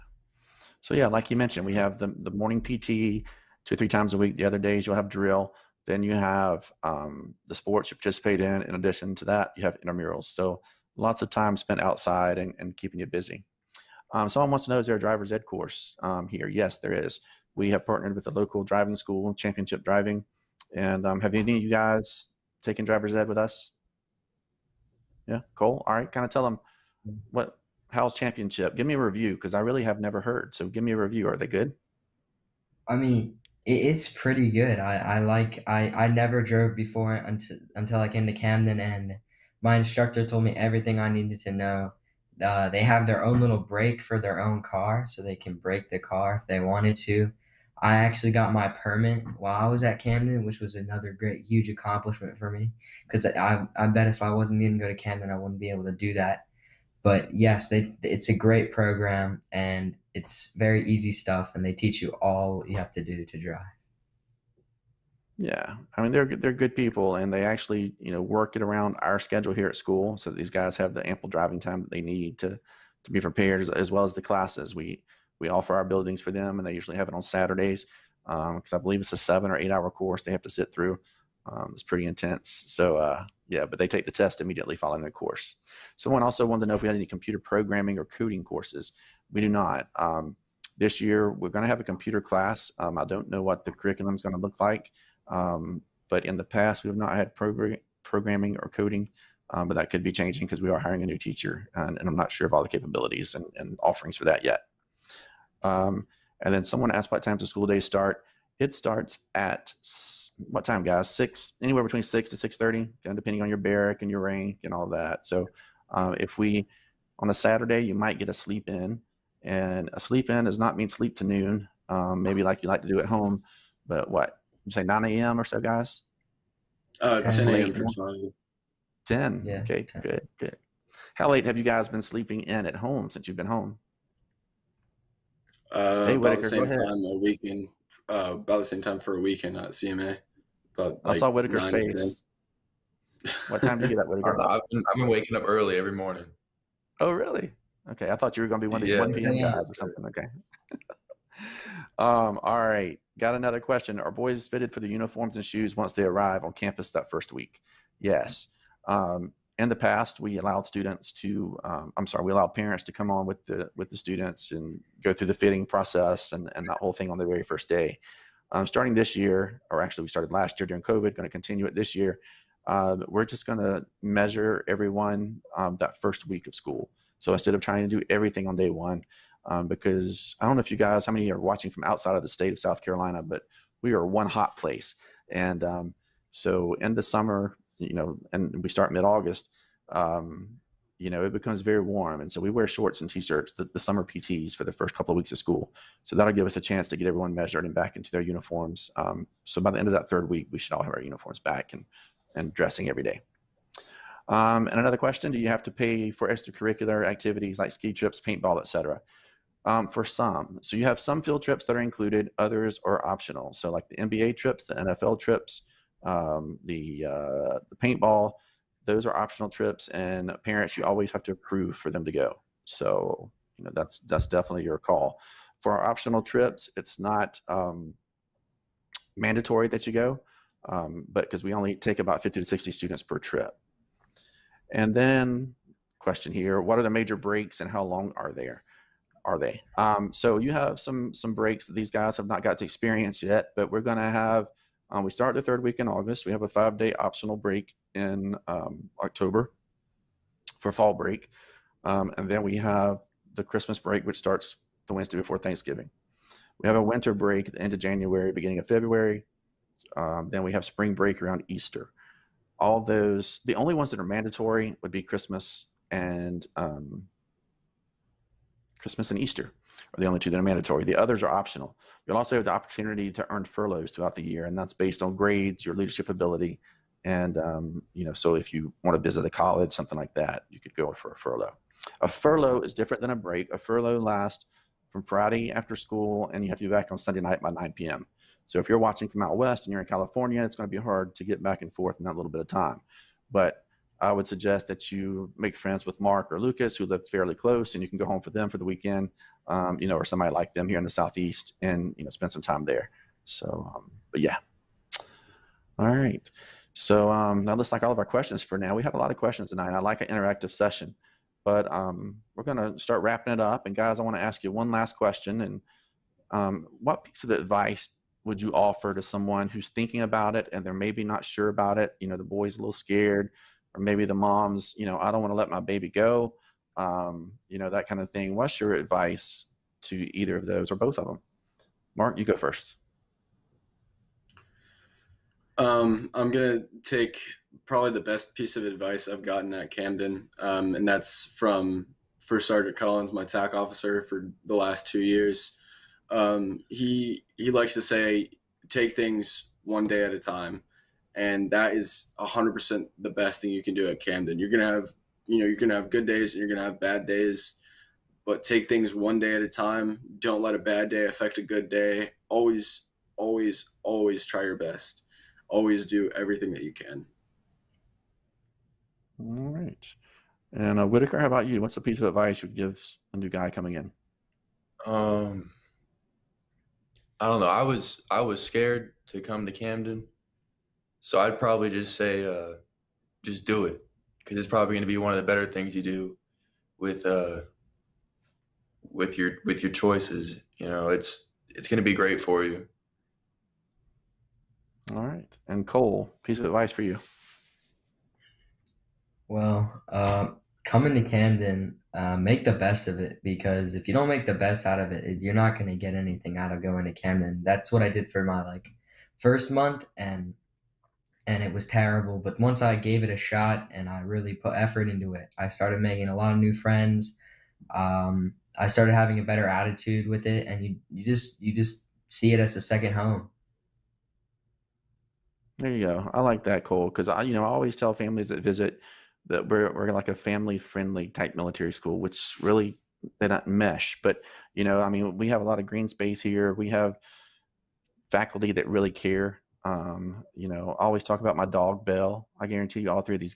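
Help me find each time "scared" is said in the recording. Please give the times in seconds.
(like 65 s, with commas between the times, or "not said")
322 s, 378 s.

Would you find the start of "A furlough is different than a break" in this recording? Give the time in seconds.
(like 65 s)
282 s.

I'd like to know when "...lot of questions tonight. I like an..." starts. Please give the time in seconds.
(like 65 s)
308 s.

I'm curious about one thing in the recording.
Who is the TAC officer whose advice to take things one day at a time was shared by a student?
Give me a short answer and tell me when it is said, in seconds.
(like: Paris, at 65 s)
First Sergeant Collins, at 342 s.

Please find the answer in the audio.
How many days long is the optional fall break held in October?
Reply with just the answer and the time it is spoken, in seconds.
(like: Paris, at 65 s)
five, at 246 s.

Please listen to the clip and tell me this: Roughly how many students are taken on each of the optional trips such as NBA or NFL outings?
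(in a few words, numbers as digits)
50 to 60.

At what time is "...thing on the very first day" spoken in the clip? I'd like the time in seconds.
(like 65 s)
166 s.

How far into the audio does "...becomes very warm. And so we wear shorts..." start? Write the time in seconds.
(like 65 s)
191 s.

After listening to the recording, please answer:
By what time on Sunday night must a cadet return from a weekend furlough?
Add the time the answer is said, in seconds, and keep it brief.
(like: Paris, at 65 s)
9 p.m., at 287 s.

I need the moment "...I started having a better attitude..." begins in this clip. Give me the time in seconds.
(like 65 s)
418 s.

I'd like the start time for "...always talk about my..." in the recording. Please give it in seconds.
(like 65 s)
440 s.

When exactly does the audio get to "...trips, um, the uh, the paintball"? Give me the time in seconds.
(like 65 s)
215 s.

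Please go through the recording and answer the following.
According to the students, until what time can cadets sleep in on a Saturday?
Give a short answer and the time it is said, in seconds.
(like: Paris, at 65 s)
10 a.m., at 127 s.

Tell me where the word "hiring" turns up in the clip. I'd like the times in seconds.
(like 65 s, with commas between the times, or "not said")
100 s.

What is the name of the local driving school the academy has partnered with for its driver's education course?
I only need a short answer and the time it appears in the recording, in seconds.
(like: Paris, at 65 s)
Championship Driving, at 19 s.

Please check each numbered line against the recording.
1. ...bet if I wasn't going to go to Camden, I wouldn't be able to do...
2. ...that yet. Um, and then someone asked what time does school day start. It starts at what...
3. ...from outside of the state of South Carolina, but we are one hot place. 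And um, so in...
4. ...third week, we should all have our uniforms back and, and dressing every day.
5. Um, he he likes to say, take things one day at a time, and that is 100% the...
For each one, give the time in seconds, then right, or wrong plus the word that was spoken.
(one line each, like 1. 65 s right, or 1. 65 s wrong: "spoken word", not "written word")
1. 53 s right
2. 104 s right
3. 181 s right
4. 200 s right
5. 346 s right.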